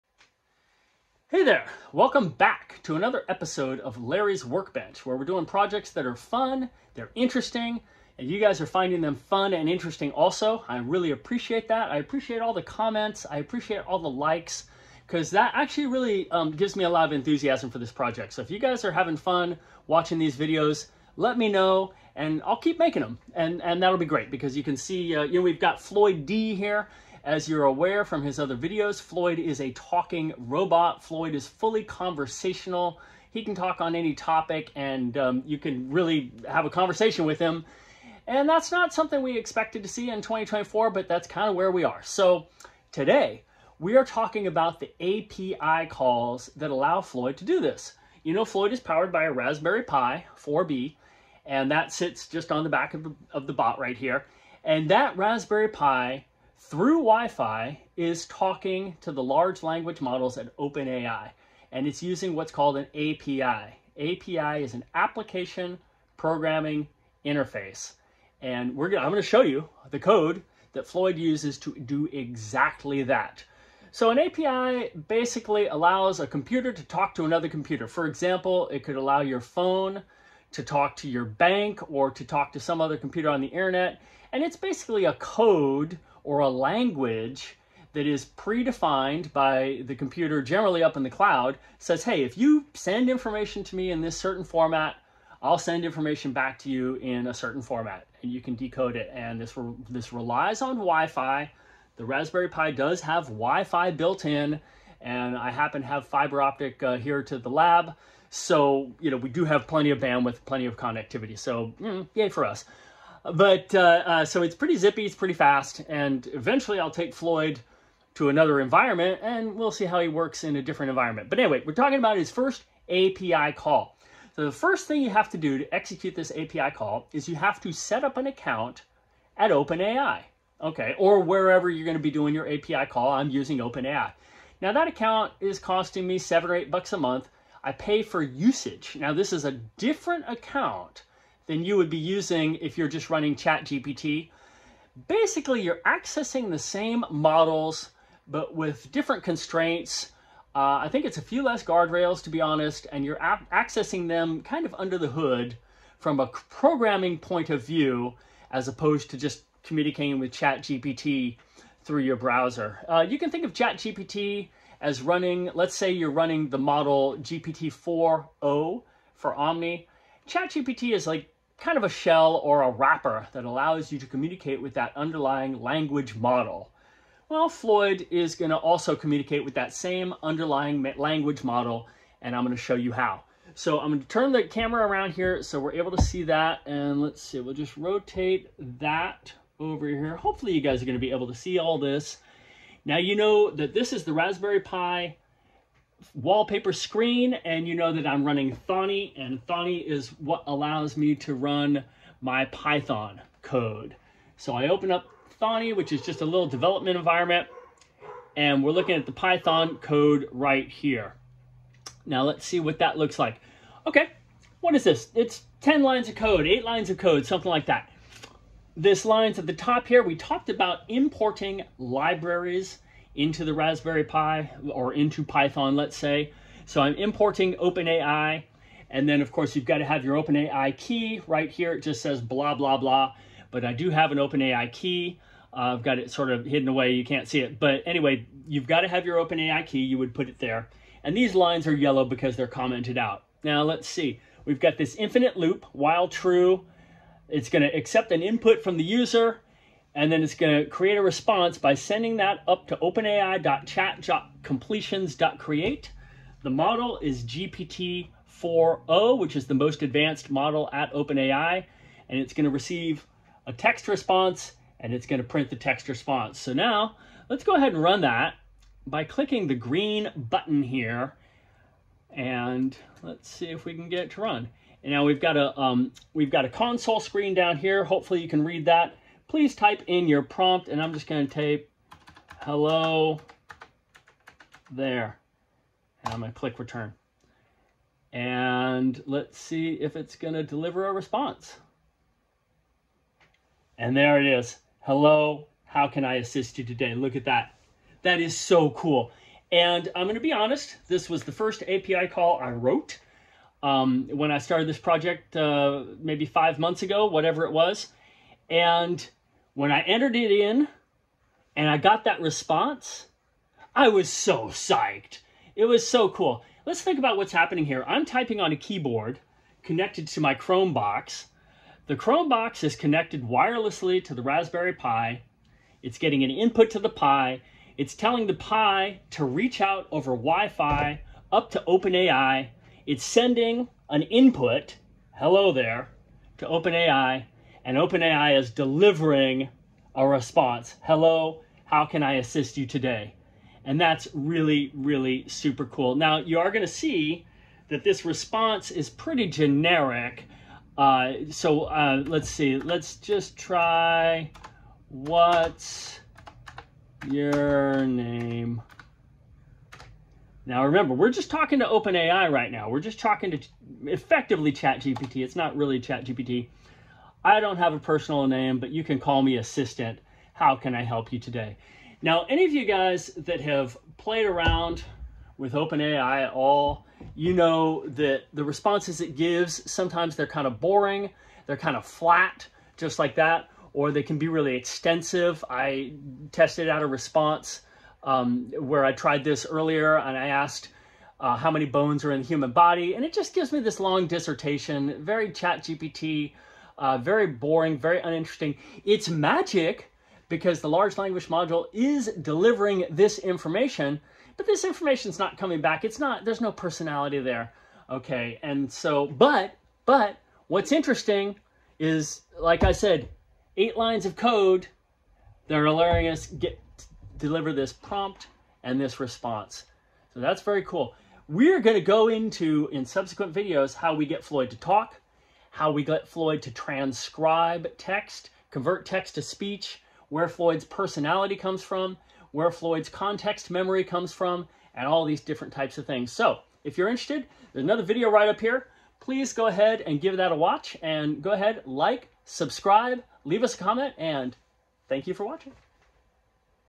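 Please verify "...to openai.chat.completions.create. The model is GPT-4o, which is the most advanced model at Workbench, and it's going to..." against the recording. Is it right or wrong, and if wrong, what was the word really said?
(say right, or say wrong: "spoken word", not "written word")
wrong: "OpenAI", not "Workbench".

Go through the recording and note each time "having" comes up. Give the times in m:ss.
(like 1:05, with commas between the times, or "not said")
0:18.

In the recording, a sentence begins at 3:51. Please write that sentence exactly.
It just says blah, blah, blah.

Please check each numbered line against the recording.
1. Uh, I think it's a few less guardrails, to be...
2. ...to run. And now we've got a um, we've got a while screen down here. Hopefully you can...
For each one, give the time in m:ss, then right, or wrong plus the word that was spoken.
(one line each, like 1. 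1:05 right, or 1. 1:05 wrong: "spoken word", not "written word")
1. 2:30 right
2. 4:34 wrong: "console", not "while".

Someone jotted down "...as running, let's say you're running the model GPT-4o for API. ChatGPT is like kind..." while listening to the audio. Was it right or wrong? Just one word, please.
wrong.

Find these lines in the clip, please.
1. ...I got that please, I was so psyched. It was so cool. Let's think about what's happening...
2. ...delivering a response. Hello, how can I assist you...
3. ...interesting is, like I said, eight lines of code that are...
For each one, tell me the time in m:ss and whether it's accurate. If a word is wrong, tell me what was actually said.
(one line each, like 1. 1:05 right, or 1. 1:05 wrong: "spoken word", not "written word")
1. 5:11 wrong: "response", not "please"
2. 5:38 right
3. 6:50 right.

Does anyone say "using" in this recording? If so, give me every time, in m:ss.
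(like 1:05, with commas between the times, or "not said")
1:02, 2:13, 2:21.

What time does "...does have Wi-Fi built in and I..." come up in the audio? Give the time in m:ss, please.
1:42.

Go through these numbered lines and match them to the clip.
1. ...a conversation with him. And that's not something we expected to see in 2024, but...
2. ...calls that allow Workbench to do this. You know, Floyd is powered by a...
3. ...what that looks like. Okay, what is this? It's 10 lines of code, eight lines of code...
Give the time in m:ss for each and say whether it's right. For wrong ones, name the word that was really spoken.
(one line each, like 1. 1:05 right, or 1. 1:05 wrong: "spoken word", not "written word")
1. 0:36 right
2. 0:45 wrong: "Floyd", not "Workbench"
3. 3:32 right.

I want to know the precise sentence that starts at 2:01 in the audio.
But anyway, we're talking about his first API call.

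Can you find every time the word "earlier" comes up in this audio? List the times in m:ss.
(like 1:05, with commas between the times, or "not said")
6:29.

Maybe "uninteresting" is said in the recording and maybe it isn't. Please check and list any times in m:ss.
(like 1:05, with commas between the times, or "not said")
6:37.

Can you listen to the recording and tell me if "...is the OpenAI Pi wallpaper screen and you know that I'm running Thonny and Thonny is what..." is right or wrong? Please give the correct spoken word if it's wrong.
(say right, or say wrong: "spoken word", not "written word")
wrong: "Raspberry", not "OpenAI".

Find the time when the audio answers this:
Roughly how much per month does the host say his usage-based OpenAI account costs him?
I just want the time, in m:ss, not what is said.
2:16.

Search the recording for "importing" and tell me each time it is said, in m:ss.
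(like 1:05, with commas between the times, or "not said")
3:40, 3:46.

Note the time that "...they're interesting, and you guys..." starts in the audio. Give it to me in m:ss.
0:06.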